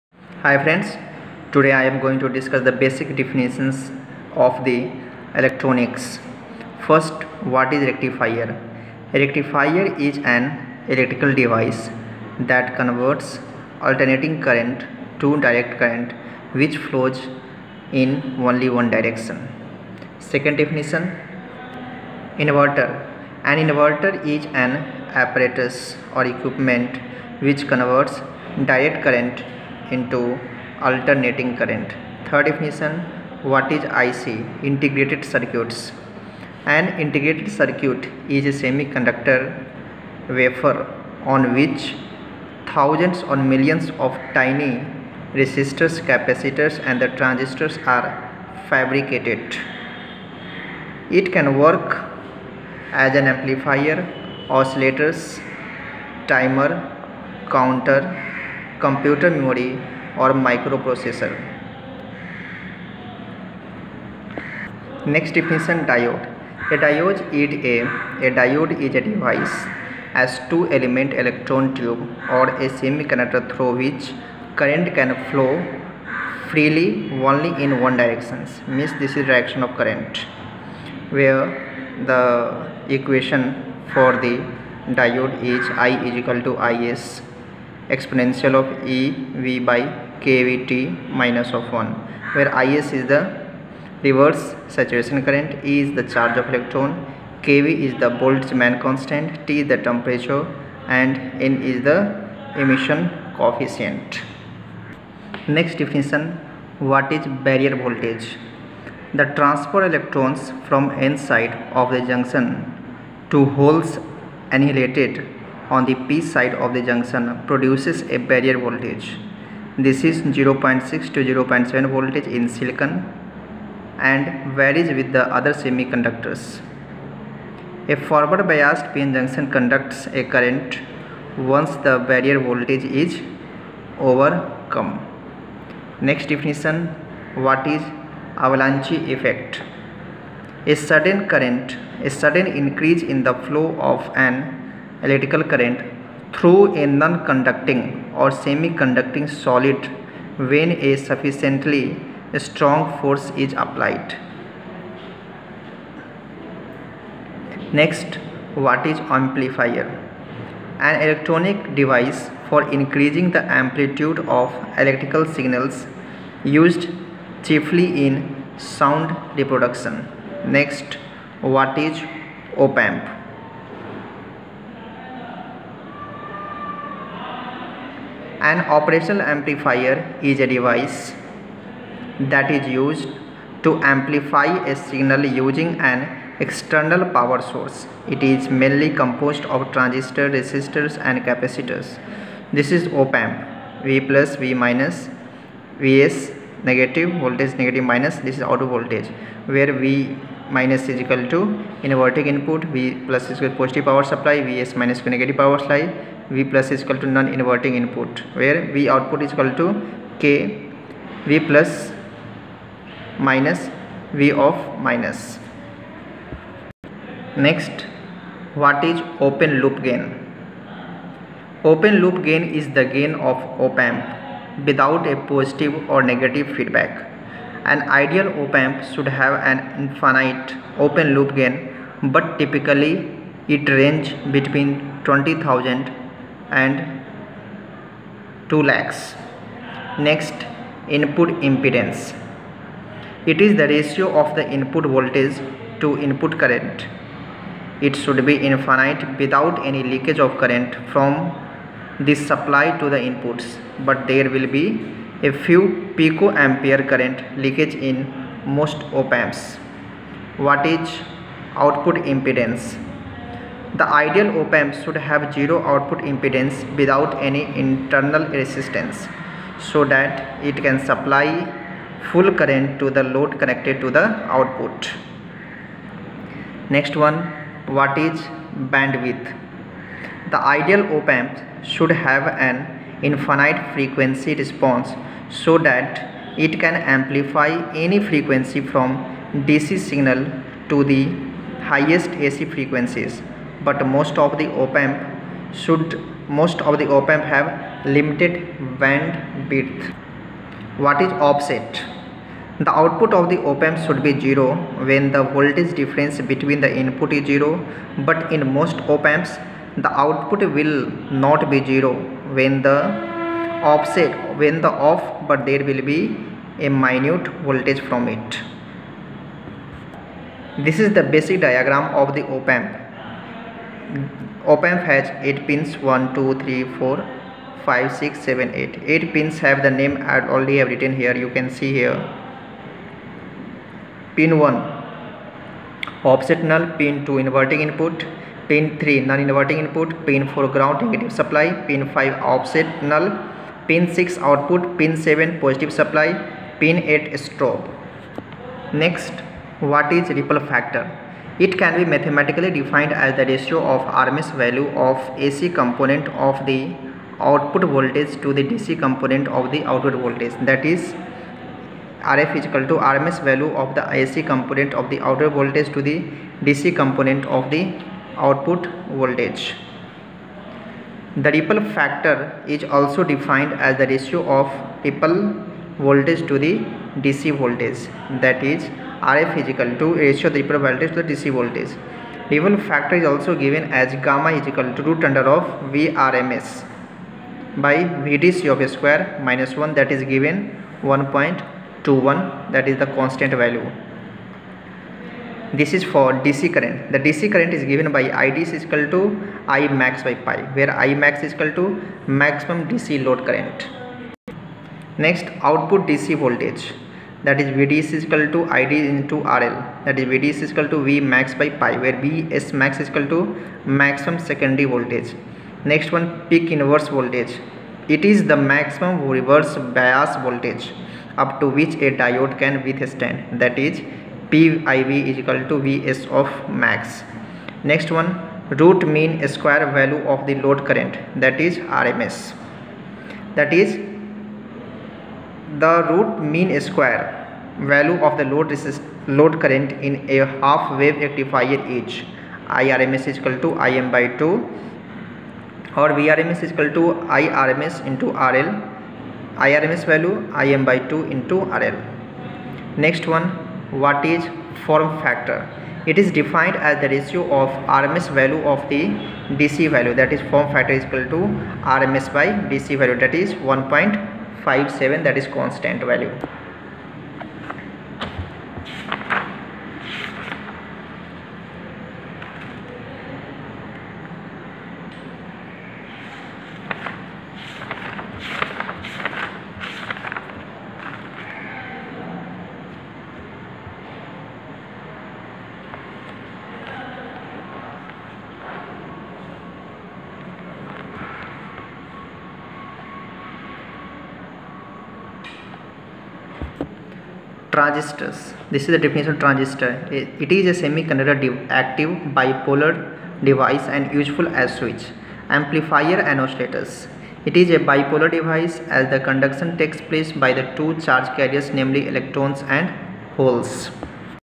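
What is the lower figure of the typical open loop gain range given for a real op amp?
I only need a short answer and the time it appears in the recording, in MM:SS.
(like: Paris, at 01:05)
20,000, at 03:55.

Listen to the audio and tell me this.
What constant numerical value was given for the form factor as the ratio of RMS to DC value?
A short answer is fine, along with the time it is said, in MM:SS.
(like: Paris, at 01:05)
1.57, at 07:43.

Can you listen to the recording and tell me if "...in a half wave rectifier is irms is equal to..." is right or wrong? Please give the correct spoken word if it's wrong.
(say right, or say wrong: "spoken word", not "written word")
right.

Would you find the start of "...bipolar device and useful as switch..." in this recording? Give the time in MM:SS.
08:22.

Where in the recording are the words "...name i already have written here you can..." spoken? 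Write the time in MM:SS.
05:29.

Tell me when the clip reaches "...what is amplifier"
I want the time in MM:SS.
02:38.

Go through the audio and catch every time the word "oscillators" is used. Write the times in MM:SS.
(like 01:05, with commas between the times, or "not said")
00:54, 08:26.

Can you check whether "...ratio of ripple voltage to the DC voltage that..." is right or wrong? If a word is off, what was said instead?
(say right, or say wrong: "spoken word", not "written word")
right.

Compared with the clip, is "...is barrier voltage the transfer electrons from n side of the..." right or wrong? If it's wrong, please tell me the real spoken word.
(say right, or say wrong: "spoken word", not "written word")
right.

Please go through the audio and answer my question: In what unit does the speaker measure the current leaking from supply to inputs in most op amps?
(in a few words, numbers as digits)
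picoampere.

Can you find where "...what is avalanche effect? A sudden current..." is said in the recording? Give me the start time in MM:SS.
02:17.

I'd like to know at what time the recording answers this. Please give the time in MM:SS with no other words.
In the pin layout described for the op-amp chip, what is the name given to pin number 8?
05:47.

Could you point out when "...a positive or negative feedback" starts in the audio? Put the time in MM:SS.
03:45.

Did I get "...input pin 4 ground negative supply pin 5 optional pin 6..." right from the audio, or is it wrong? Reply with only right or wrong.
right.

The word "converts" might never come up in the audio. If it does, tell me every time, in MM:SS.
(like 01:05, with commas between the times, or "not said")
00:12, 00:27.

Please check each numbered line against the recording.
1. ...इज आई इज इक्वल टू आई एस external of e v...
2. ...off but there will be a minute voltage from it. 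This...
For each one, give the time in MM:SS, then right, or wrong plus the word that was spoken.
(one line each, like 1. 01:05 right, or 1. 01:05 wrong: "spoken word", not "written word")
1. 01:25 wrong: "exponential", not "external"
2. 05:14 right.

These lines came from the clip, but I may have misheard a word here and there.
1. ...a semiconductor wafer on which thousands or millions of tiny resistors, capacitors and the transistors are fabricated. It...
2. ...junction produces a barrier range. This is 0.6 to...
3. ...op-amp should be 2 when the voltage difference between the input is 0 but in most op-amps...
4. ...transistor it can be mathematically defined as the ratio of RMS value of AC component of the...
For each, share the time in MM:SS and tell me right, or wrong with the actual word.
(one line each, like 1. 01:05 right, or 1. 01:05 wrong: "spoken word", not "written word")
1. 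00:38 right
2. 01:56 wrong: "voltage", not "range"
3. 05:03 wrong: "0", not "2"
4. 05:50 wrong: "factor", not "transistor".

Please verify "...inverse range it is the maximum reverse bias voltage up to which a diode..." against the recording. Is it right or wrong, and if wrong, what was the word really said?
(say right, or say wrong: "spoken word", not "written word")
wrong: "voltage", not "range".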